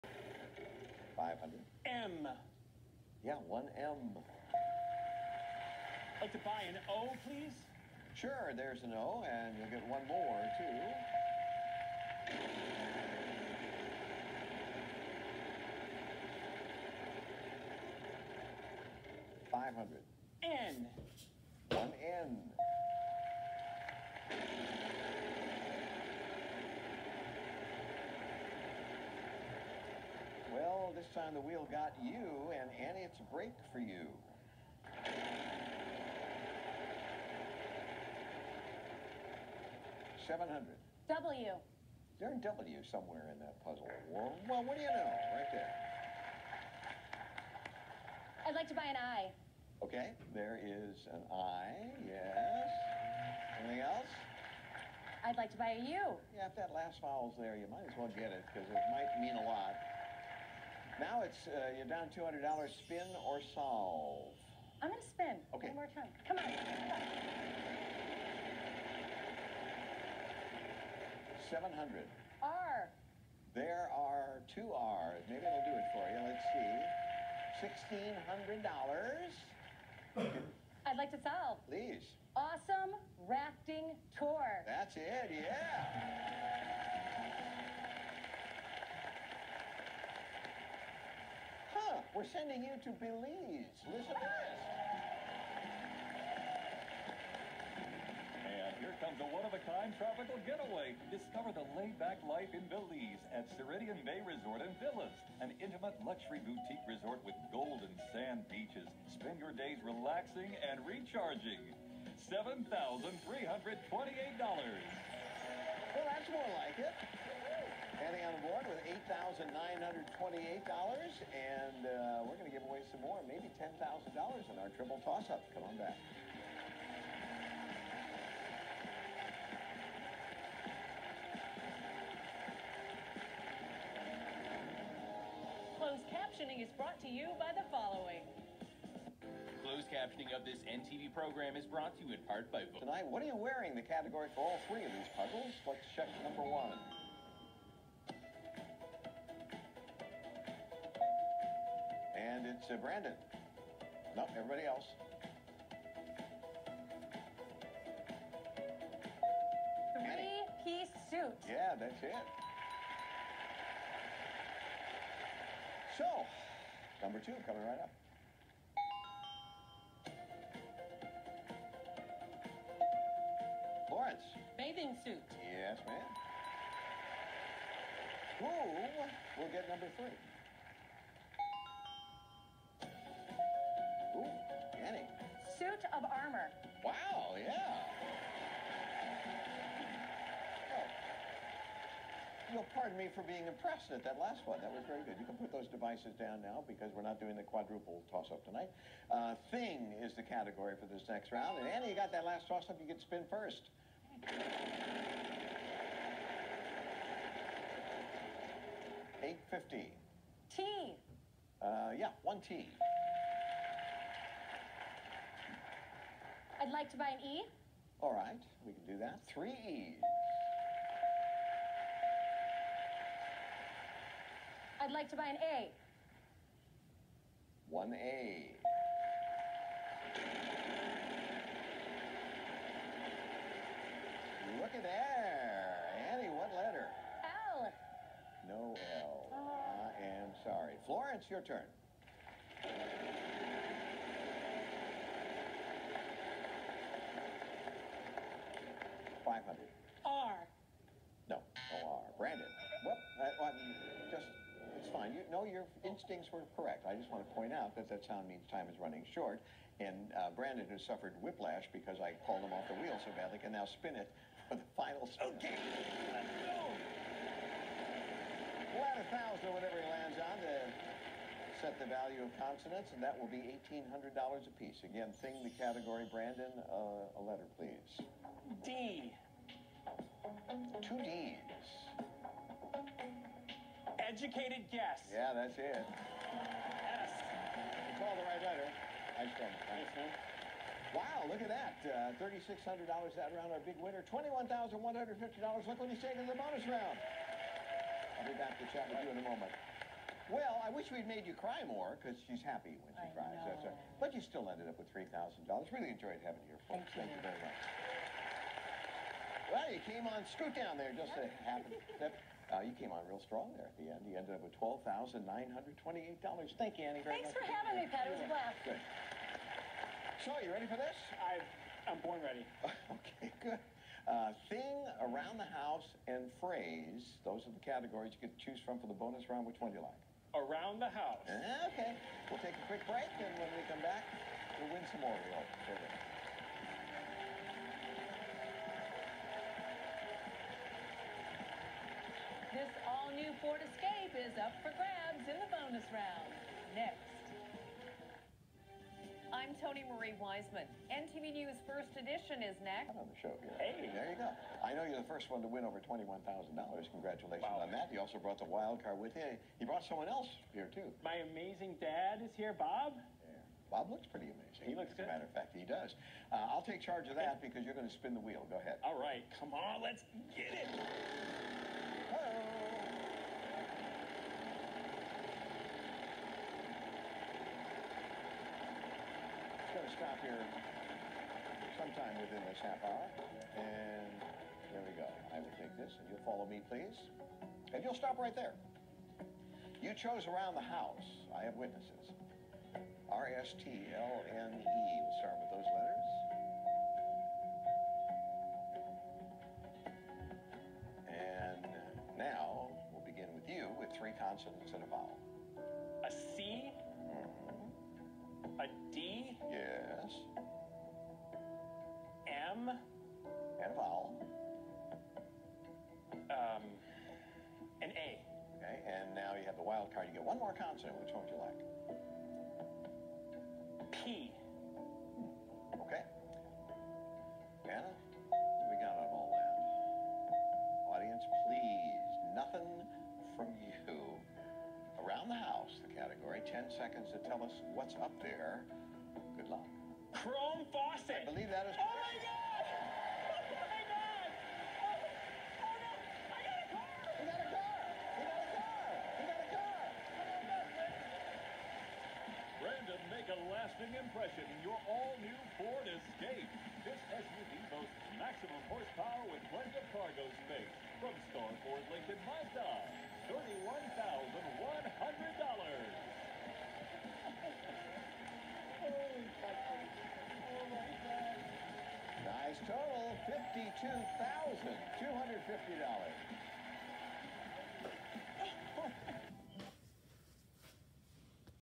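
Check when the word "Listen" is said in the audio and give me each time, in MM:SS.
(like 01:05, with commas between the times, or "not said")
01:33.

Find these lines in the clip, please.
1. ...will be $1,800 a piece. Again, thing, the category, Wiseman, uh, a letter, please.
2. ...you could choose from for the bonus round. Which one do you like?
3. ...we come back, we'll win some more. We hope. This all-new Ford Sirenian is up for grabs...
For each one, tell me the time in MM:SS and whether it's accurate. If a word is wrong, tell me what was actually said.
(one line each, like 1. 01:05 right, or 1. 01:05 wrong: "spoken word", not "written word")
1. 04:33 wrong: "Brandon", not "Wiseman"
2. 05:28 right
3. 05:33 wrong: "Escape", not "Sirenian".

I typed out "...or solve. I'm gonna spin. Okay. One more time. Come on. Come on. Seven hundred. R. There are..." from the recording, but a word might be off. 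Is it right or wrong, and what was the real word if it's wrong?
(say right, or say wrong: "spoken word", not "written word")
right.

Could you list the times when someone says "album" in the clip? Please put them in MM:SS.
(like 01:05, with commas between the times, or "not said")
not said.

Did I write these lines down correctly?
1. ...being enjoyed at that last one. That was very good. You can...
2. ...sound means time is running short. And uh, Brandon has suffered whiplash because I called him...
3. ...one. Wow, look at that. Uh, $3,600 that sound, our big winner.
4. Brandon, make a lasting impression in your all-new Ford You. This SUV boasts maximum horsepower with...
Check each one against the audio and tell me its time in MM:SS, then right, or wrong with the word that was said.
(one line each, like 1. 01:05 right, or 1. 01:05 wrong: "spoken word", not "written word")
1. 03:13 wrong: "impressed", not "enjoyed"
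2. 04:18 right
3. 04:49 wrong: "round", not "sound"
4. 07:32 wrong: "Escape", not "You".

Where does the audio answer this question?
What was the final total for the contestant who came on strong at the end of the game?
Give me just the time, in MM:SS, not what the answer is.
05:14.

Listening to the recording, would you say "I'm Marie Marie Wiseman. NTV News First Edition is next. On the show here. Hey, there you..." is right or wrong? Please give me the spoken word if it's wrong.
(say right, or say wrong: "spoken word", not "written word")
wrong: "Tony", not "Marie".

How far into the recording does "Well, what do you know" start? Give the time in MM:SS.
00:44.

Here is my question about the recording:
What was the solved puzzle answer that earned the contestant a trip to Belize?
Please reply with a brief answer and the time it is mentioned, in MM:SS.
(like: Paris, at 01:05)
Awesome rafting tour, at 01:22.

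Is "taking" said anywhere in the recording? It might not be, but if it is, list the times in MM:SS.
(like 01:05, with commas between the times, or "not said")
04:56.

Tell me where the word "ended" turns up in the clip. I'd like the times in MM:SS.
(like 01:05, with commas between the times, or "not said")
05:04, 05:14.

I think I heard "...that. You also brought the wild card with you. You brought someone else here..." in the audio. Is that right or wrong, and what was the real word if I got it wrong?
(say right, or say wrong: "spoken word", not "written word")
right.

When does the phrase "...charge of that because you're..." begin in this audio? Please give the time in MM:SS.
06:06.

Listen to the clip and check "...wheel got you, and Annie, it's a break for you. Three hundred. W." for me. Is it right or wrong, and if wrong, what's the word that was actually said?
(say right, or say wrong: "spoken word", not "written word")
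wrong: "Seven", not "Three".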